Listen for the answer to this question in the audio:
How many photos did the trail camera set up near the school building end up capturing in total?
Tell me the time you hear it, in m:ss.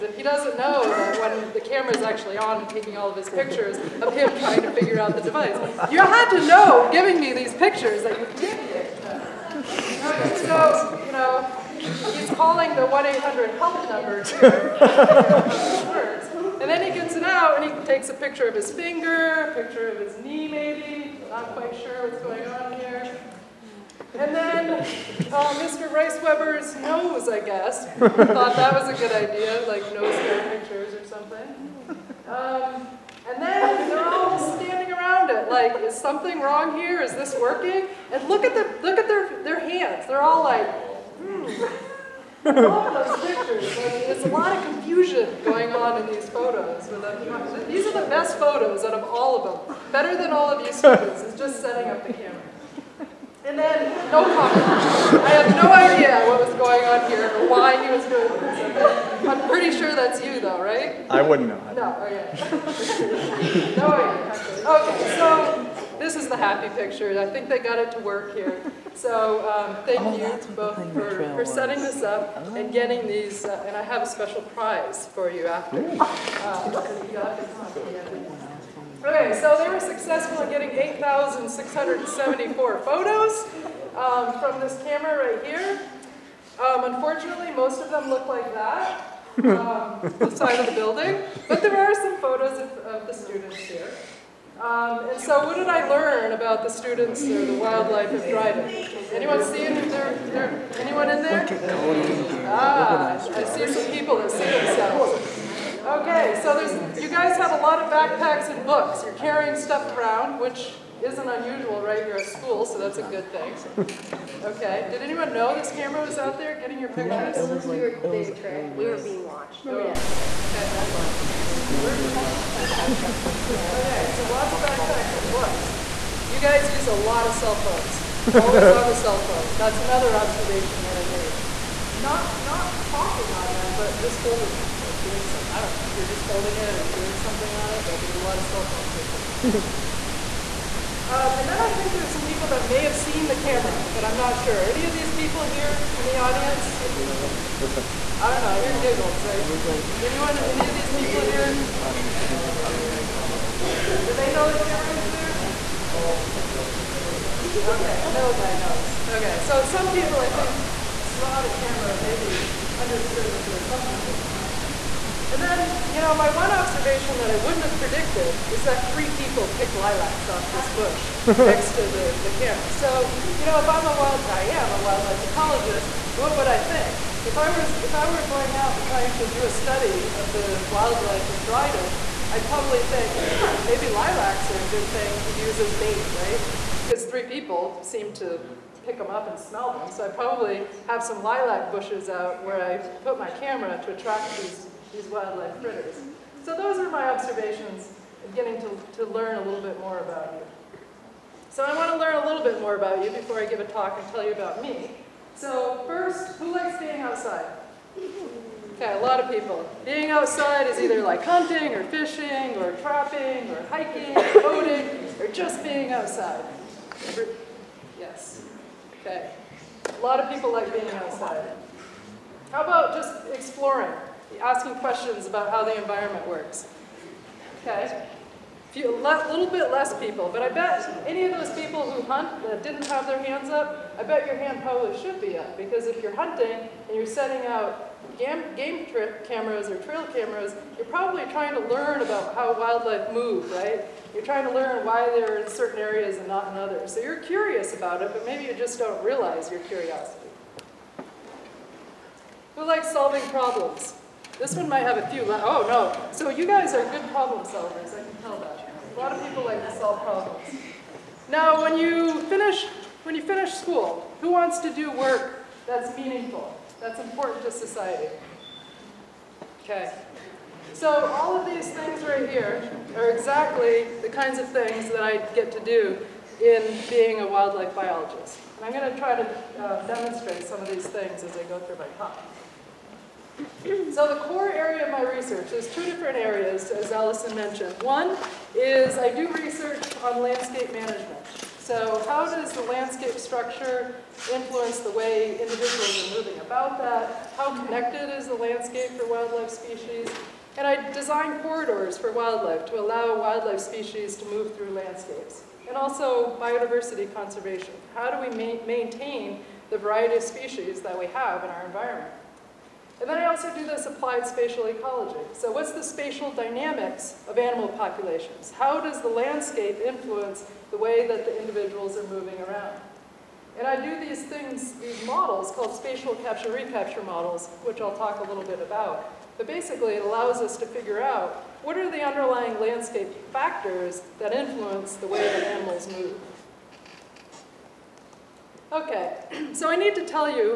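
1:20.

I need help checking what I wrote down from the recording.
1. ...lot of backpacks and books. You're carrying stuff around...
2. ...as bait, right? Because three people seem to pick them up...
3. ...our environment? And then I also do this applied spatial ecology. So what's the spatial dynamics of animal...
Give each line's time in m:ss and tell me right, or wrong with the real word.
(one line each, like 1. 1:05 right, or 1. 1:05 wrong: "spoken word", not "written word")
1. 1:47 right
2. 3:05 right
3. 5:11 right.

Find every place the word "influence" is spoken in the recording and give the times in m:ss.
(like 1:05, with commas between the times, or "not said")
4:54, 5:19, 5:34.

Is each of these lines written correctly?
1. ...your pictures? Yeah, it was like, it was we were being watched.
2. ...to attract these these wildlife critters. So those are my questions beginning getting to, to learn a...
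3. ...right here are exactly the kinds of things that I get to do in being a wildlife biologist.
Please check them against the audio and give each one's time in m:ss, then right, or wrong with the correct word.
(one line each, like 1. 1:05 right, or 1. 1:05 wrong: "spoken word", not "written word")
1. 1:56 right
2. 3:13 wrong: "observations", not "questions"
3. 4:32 right.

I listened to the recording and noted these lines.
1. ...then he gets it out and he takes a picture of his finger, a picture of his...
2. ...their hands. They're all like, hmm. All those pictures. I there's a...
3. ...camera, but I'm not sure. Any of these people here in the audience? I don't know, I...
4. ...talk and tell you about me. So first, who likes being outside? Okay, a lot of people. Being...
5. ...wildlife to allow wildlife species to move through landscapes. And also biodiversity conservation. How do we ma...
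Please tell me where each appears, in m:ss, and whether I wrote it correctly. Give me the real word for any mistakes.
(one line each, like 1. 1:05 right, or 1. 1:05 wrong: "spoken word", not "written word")
1. 0:16 right
2. 0:39 right
3. 2:23 right
4. 3:23 right
5. 5:02 right.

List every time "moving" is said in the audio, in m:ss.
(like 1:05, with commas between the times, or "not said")
4:56, 5:22.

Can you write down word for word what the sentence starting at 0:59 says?
I'm pretty sure that's you, though, right?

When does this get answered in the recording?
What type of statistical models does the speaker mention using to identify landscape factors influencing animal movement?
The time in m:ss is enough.
5:25.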